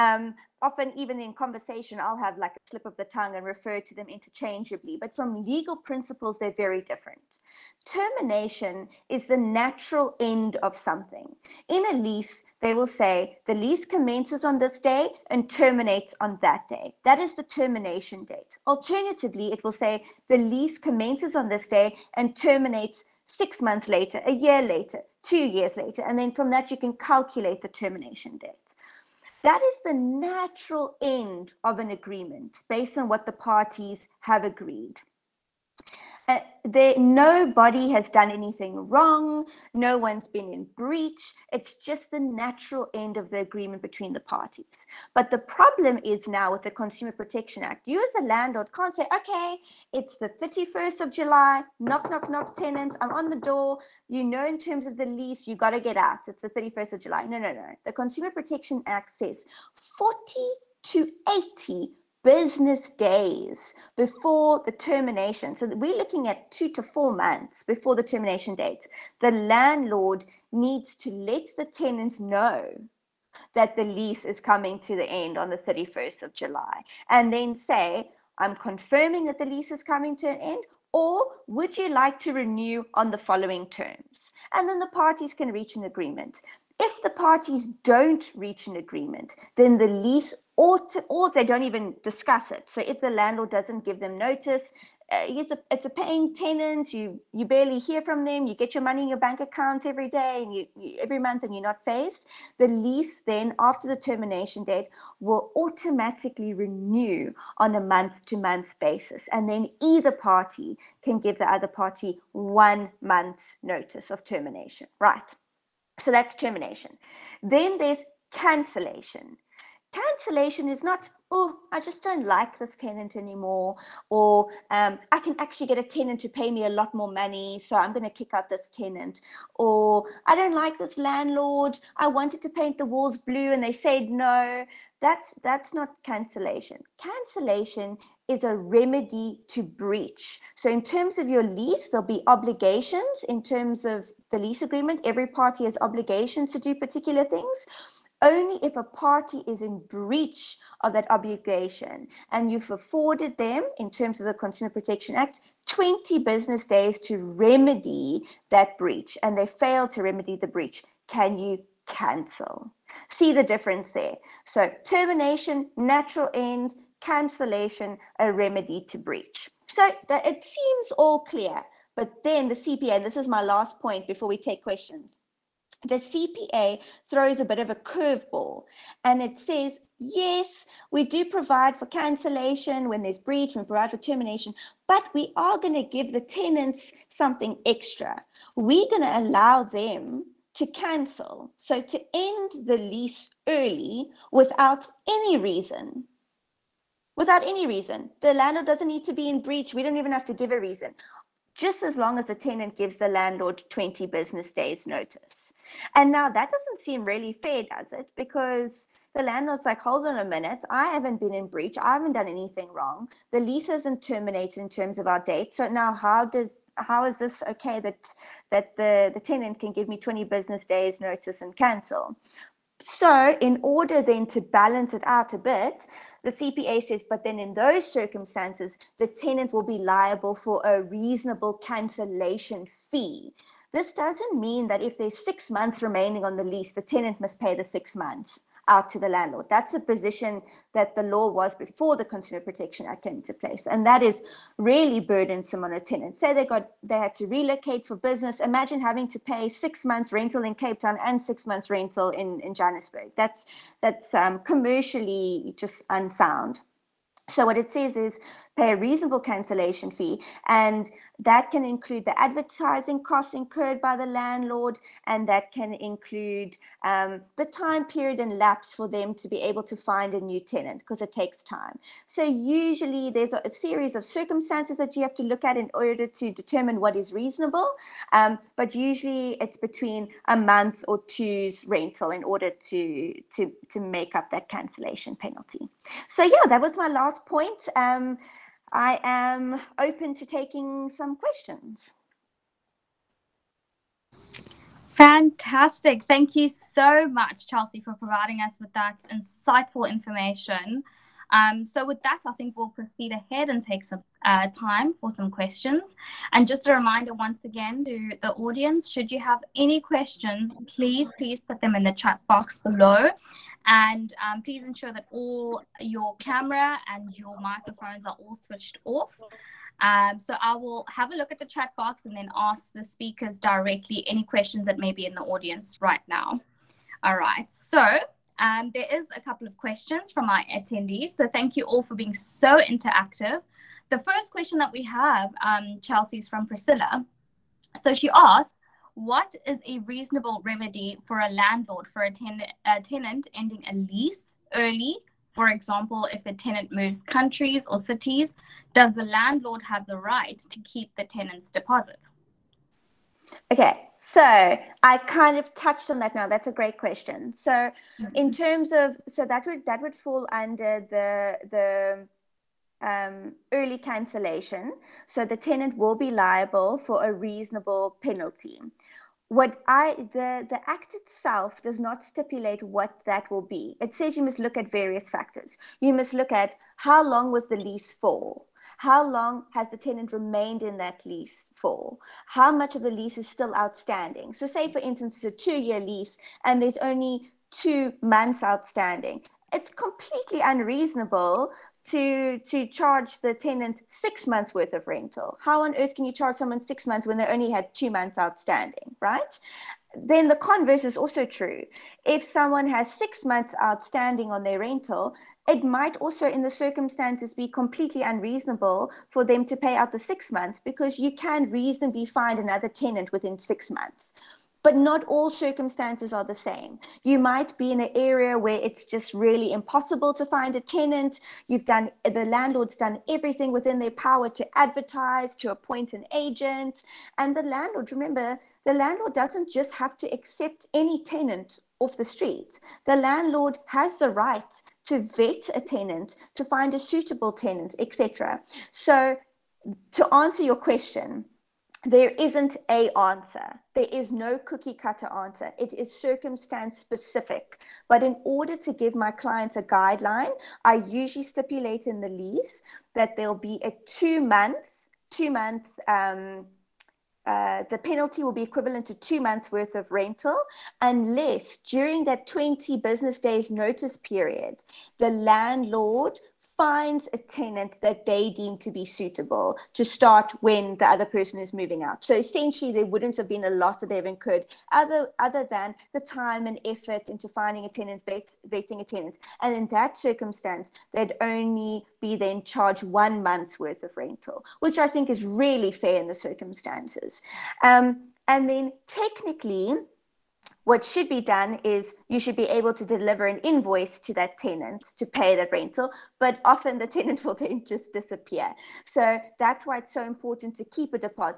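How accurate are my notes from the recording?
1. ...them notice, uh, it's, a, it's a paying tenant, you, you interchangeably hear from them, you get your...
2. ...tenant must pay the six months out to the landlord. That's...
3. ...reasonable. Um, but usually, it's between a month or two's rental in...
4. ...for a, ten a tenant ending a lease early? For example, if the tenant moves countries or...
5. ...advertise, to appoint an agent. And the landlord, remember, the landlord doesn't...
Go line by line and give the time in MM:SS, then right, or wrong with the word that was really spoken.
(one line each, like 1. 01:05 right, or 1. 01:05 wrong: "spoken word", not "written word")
1. 01:33 wrong: "barely", not "interchangeably"
2. 03:56 right
3. 04:37 right
4. 05:41 right
5. 07:04 right.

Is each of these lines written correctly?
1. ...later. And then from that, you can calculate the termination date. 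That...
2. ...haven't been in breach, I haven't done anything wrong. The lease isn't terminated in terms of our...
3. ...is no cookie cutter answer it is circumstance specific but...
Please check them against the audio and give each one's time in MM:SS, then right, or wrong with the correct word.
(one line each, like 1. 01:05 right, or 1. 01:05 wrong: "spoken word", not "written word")
1. 00:25 right
2. 03:30 right
3. 07:23 right.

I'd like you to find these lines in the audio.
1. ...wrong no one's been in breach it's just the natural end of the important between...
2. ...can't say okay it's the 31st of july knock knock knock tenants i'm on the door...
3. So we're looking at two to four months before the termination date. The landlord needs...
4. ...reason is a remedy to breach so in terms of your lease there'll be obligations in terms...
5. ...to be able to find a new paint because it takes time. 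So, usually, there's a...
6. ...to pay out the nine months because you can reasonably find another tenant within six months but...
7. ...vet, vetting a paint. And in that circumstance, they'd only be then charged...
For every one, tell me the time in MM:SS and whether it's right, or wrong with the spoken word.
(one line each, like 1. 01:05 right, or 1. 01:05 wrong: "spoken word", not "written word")
1. 00:38 wrong: "agreement", not "important"
2. 00:48 right
3. 01:05 right
4. 02:16 wrong: "cancellation", not "reason"
5. 04:29 wrong: "tenant", not "paint"
6. 06:49 wrong: "six", not "nine"
7. 07:58 wrong: "tenant", not "paint".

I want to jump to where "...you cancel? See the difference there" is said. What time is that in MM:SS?
02:41.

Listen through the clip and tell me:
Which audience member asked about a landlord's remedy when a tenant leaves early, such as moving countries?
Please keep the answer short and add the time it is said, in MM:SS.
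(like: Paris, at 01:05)
Priscilla, at 05:36.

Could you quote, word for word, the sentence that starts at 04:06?
Say they got they had to relocate for business.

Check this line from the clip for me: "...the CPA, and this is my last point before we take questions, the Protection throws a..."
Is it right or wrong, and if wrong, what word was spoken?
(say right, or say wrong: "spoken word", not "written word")
wrong: "CPA", not "Protection".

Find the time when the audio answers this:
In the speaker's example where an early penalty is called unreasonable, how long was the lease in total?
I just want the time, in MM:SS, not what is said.
06:25.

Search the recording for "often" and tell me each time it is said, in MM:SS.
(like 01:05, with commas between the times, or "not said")
00:00, 08:16.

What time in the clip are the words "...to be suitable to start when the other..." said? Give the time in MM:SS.
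07:48.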